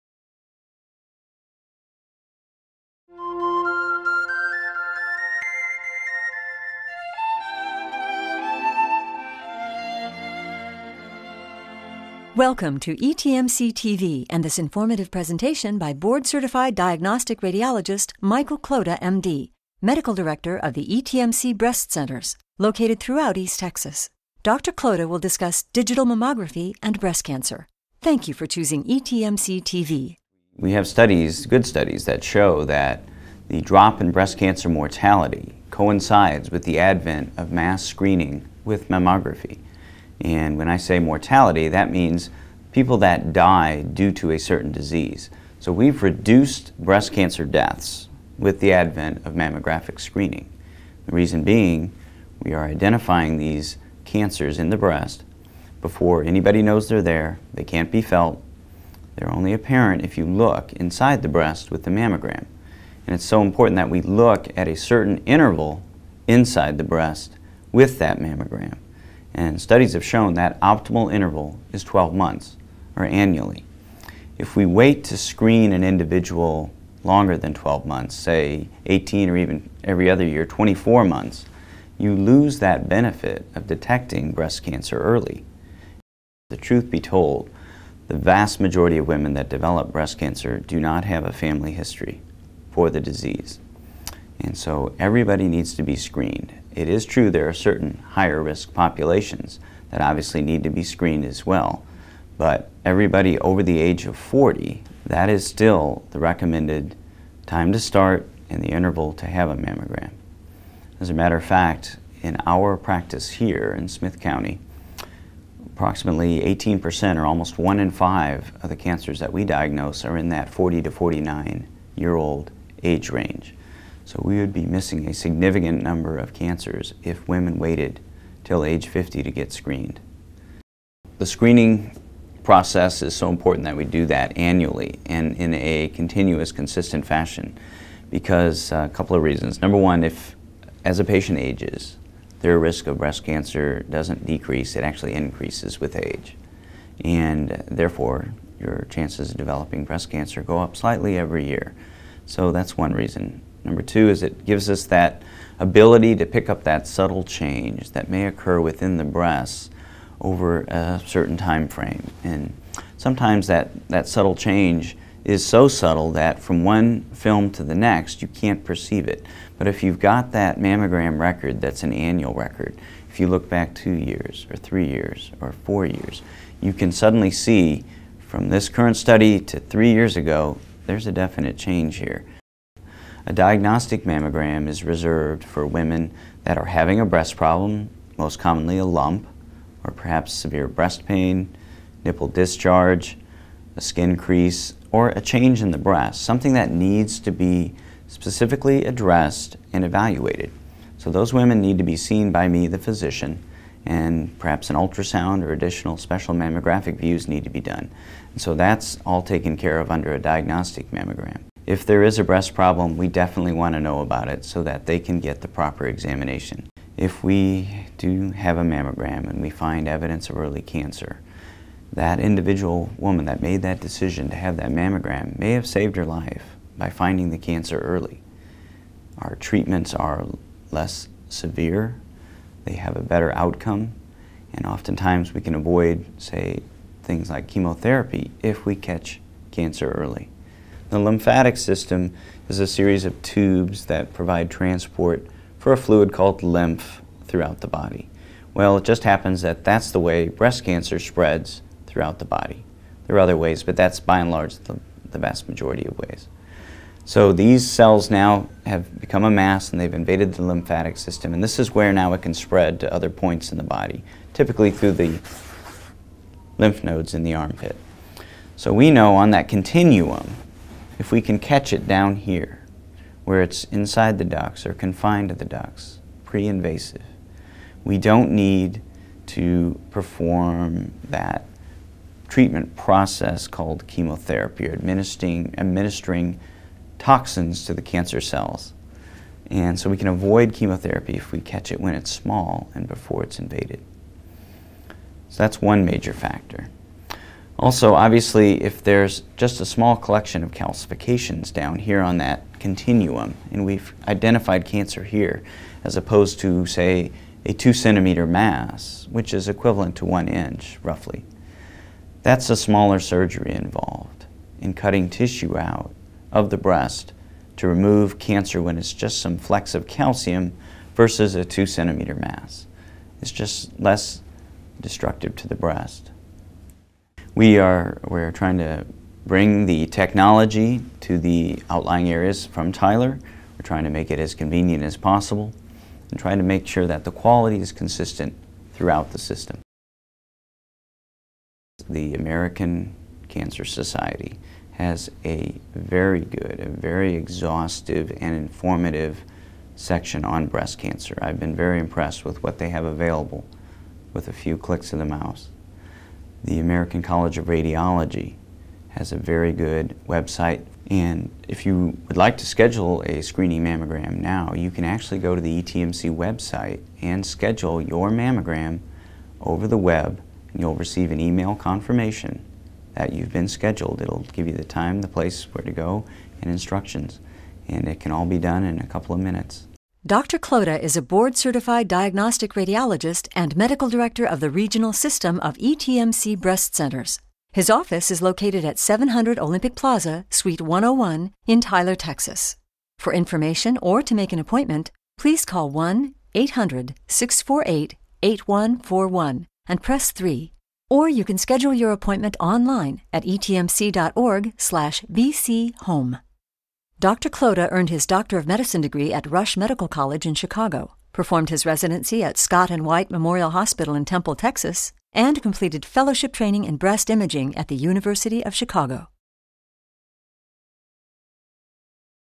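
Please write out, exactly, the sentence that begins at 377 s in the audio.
And it can all be done in a couple of minutes.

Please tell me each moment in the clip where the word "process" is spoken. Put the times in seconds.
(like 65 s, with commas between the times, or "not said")
132 s, 282 s.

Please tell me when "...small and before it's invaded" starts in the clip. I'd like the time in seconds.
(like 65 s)
292 s.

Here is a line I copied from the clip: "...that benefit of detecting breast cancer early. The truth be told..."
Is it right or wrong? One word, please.
right.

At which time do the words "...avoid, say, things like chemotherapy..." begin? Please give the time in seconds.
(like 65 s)
235 s.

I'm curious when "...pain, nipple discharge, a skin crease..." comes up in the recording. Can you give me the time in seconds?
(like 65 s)
191 s.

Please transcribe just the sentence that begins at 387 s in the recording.
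His office is located at 700 Olympic Plaza, Suite 101 in Tyler, Texas.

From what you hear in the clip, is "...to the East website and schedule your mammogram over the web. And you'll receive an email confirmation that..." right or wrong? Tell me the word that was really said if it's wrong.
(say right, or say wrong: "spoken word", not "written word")
wrong: "ETMC", not "East".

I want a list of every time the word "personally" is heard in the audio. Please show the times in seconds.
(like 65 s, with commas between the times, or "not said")
not said.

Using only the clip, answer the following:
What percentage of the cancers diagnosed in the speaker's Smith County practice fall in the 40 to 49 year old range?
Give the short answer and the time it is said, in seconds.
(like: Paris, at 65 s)
18%, at 115 s.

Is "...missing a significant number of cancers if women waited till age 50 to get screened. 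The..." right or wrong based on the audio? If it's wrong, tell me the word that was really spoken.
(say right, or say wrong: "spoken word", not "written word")
right.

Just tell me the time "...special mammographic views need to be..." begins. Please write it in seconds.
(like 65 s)
205 s.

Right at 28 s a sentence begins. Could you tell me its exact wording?
Thank you for choosing ETMC TV.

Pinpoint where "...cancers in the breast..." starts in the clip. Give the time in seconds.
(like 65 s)
54 s.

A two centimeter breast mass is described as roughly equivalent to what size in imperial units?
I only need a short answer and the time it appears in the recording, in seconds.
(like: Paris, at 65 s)
1 inch, at 310 s.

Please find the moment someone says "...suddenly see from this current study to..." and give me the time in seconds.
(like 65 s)
176 s.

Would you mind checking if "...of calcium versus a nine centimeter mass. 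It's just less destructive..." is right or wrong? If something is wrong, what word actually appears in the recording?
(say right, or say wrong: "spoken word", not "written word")
wrong: "two", not "nine".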